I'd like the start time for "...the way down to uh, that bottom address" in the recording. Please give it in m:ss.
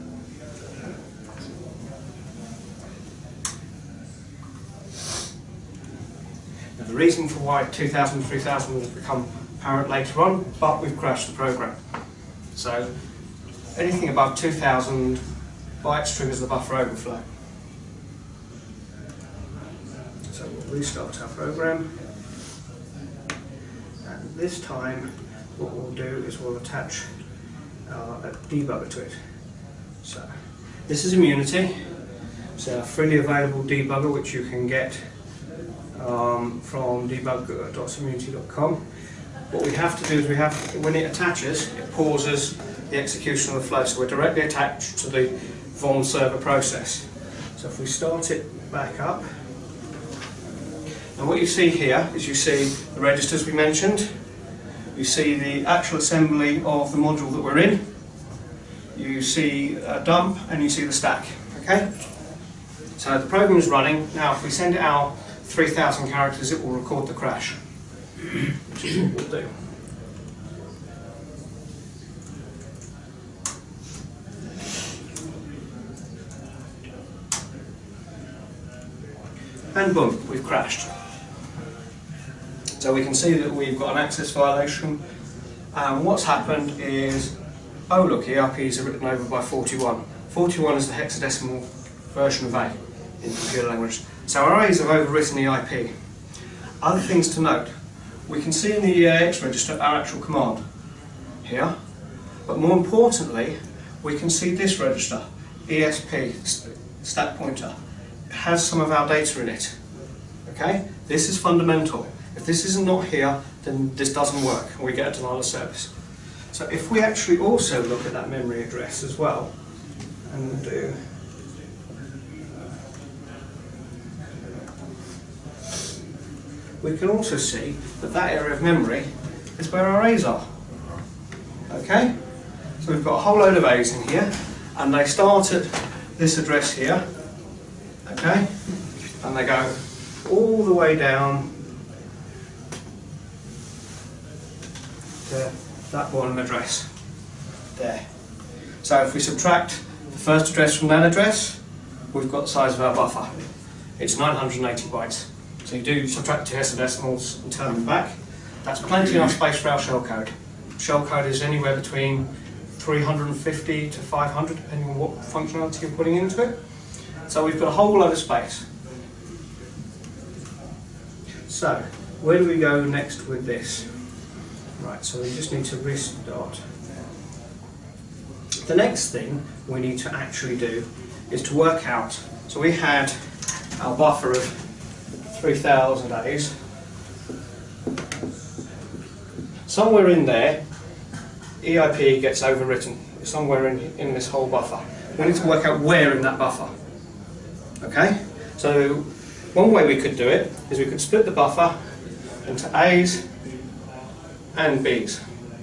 2:20.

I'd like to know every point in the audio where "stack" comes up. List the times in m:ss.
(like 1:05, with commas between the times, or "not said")
1:00, 1:47.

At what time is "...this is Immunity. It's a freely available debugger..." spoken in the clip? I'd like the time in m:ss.
0:30.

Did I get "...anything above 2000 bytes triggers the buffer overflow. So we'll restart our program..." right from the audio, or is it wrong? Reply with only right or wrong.
right.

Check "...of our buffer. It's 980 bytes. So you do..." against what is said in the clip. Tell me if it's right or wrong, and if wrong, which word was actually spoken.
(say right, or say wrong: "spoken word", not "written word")
right.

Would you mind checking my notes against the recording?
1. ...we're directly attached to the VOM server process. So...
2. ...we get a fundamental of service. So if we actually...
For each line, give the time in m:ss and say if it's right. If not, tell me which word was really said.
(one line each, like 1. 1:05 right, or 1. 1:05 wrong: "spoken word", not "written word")
1. 0:43 right
2. 1:54 wrong: "denial", not "fundamental".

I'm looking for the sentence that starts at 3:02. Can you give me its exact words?
So we had our buffer of 3,000 A's.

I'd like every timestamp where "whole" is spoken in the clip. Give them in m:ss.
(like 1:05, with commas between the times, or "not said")
2:13, 2:47, 3:14.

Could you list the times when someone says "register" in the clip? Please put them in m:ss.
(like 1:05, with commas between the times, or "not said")
0:52, 1:39, 1:44.